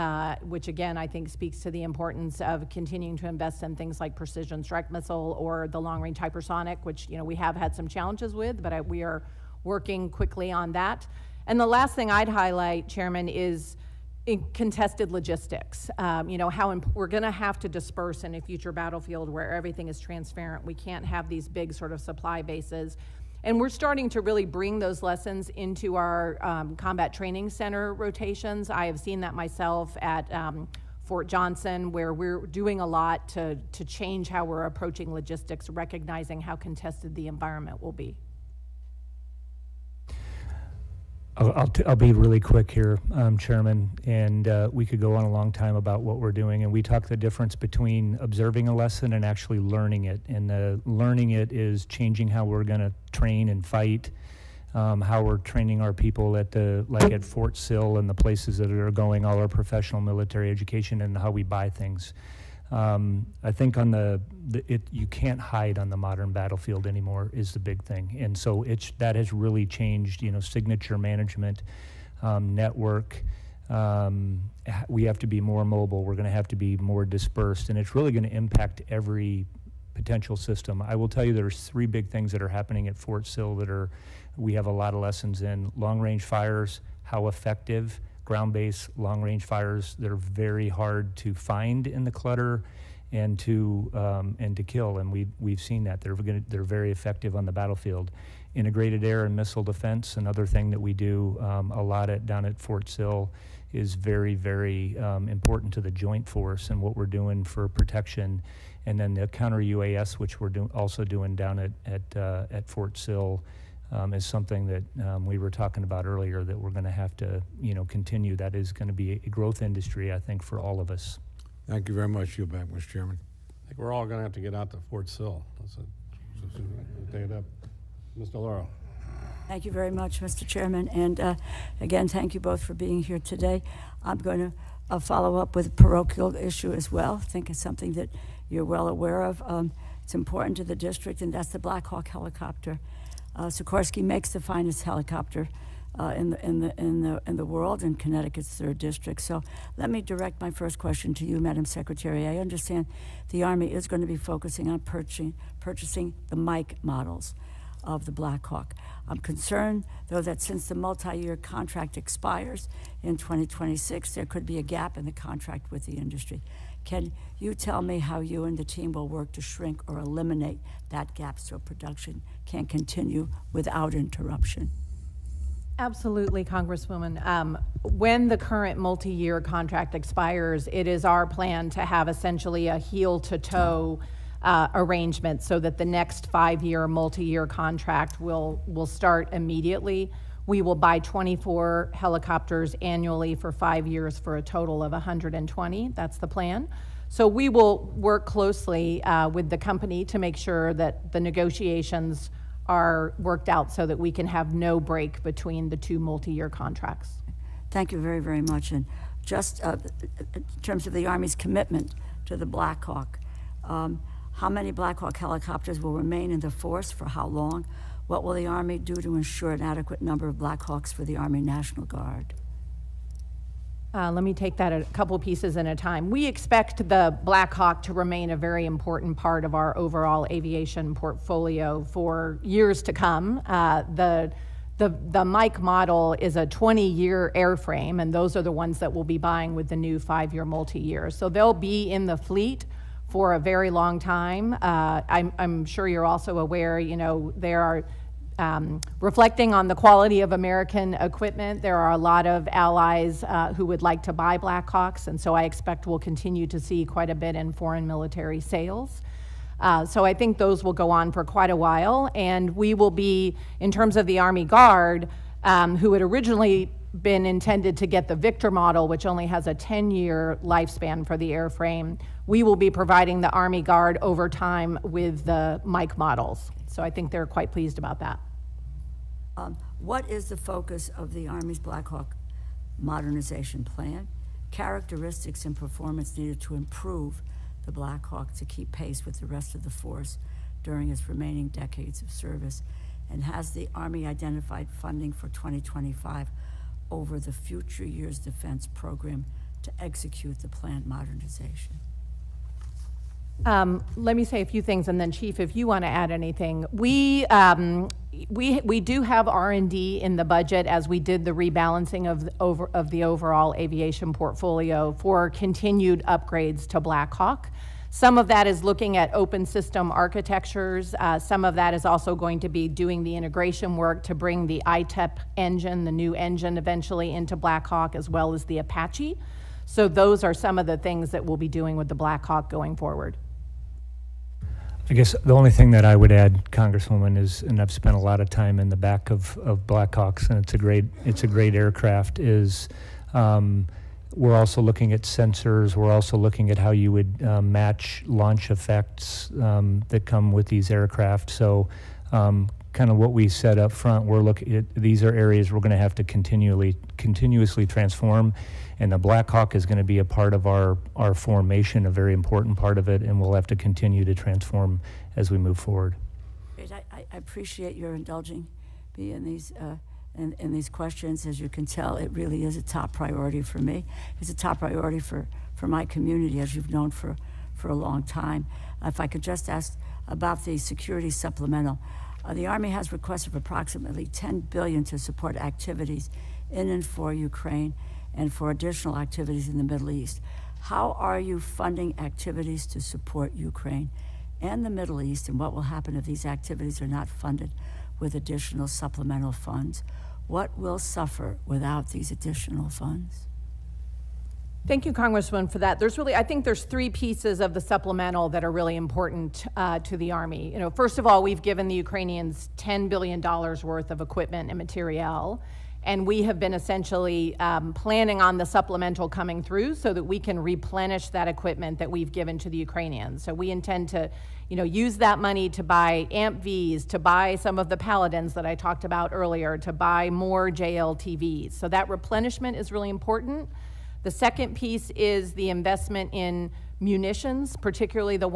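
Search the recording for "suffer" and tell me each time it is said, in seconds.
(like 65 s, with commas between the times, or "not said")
400 s.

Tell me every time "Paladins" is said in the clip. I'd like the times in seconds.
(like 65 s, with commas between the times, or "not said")
427 s.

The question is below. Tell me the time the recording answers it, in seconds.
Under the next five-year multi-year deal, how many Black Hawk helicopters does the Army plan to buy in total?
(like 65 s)
194 s.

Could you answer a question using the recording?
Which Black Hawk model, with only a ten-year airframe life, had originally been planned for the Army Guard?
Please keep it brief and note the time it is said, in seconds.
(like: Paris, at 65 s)
Victor model, at 268 s.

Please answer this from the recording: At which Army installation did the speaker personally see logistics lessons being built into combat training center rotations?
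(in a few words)
Fort Johnson.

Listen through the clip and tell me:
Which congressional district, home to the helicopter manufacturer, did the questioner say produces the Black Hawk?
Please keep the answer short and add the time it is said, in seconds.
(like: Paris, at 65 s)
Connecticut's third district, at 147 s.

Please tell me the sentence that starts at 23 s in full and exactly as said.
And we're starting to really bring those lessons into our um, combat training center rotations.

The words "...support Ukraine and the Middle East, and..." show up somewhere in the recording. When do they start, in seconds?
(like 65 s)
392 s.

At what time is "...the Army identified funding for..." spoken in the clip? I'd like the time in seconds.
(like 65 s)
293 s.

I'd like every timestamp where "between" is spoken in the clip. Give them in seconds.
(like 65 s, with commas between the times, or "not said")
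47 s, 205 s.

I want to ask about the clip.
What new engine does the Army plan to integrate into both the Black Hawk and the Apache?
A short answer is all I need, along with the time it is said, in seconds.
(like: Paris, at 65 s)
ITEP, at 324 s.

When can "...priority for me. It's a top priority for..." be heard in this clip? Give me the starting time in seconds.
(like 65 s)
372 s.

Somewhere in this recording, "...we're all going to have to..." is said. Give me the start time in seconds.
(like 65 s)
123 s.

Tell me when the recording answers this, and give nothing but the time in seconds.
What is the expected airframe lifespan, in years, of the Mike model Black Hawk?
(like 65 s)
236 s.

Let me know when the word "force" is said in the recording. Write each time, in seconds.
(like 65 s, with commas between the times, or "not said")
106 s, 216 s, 289 s.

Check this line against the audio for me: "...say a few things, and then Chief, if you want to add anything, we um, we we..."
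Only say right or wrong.
right.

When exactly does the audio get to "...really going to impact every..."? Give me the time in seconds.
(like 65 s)
77 s.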